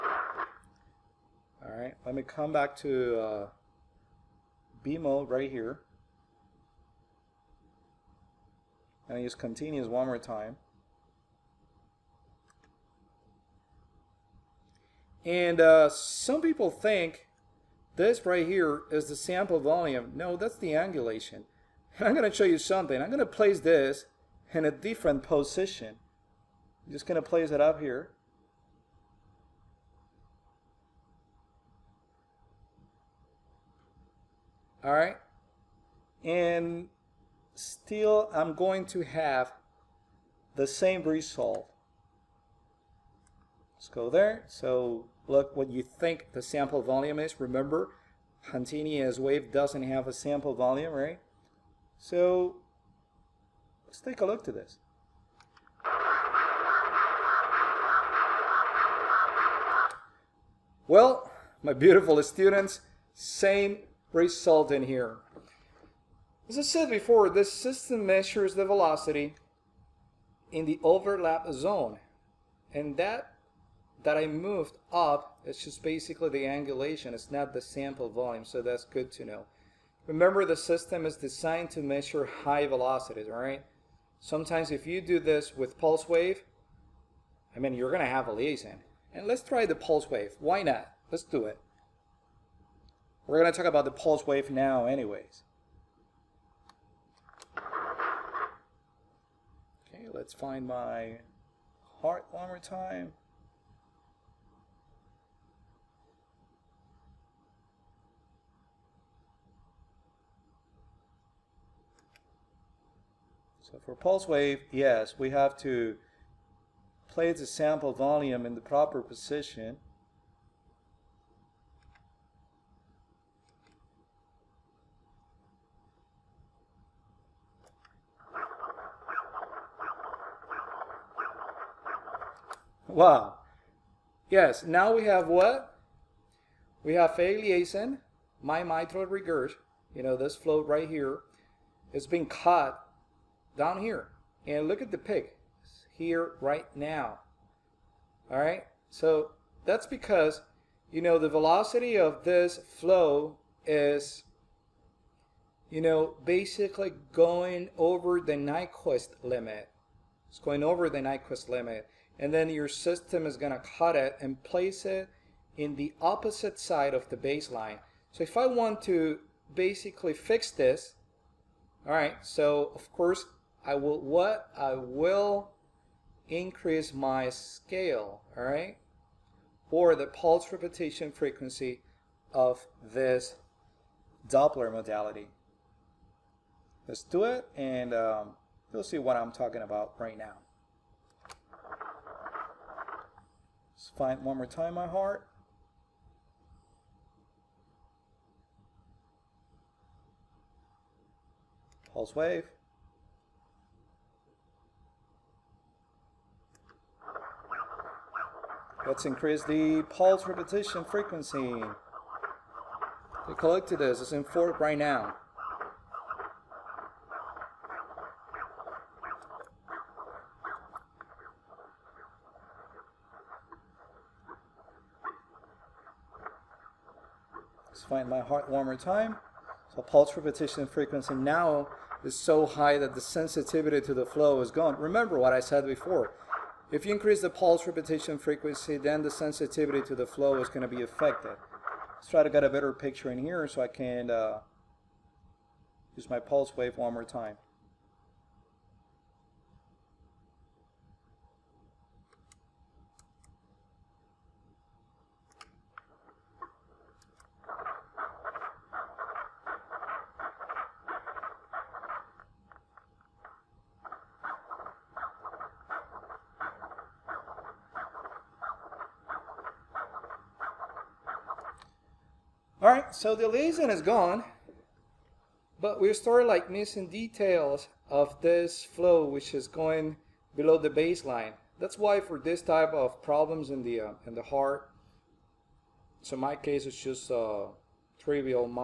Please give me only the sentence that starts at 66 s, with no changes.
As I said before, this system measures the velocity in the overlap zone.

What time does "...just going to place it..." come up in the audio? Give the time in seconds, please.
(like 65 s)
26 s.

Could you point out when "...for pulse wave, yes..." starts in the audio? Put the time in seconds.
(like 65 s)
113 s.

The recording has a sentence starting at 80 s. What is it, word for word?
Remember, the system is designed to measure high velocities, all right?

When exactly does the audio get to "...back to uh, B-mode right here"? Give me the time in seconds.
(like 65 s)
2 s.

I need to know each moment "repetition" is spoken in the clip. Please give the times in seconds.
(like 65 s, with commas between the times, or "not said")
180 s, 210 s, 230 s, 237 s.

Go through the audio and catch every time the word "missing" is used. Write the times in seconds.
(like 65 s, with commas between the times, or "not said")
276 s.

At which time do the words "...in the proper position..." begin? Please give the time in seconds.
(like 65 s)
118 s.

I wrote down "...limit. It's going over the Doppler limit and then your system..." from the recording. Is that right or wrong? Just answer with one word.
wrong.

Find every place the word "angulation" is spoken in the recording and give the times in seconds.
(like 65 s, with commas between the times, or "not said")
20 s, 76 s.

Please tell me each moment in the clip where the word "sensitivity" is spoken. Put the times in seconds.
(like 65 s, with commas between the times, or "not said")
233 s, 239 s.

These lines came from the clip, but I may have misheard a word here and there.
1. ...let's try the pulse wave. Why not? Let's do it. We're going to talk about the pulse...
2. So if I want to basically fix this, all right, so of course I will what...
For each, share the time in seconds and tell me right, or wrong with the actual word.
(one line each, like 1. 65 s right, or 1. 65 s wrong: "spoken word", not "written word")
1. 89 s right
2. 168 s right.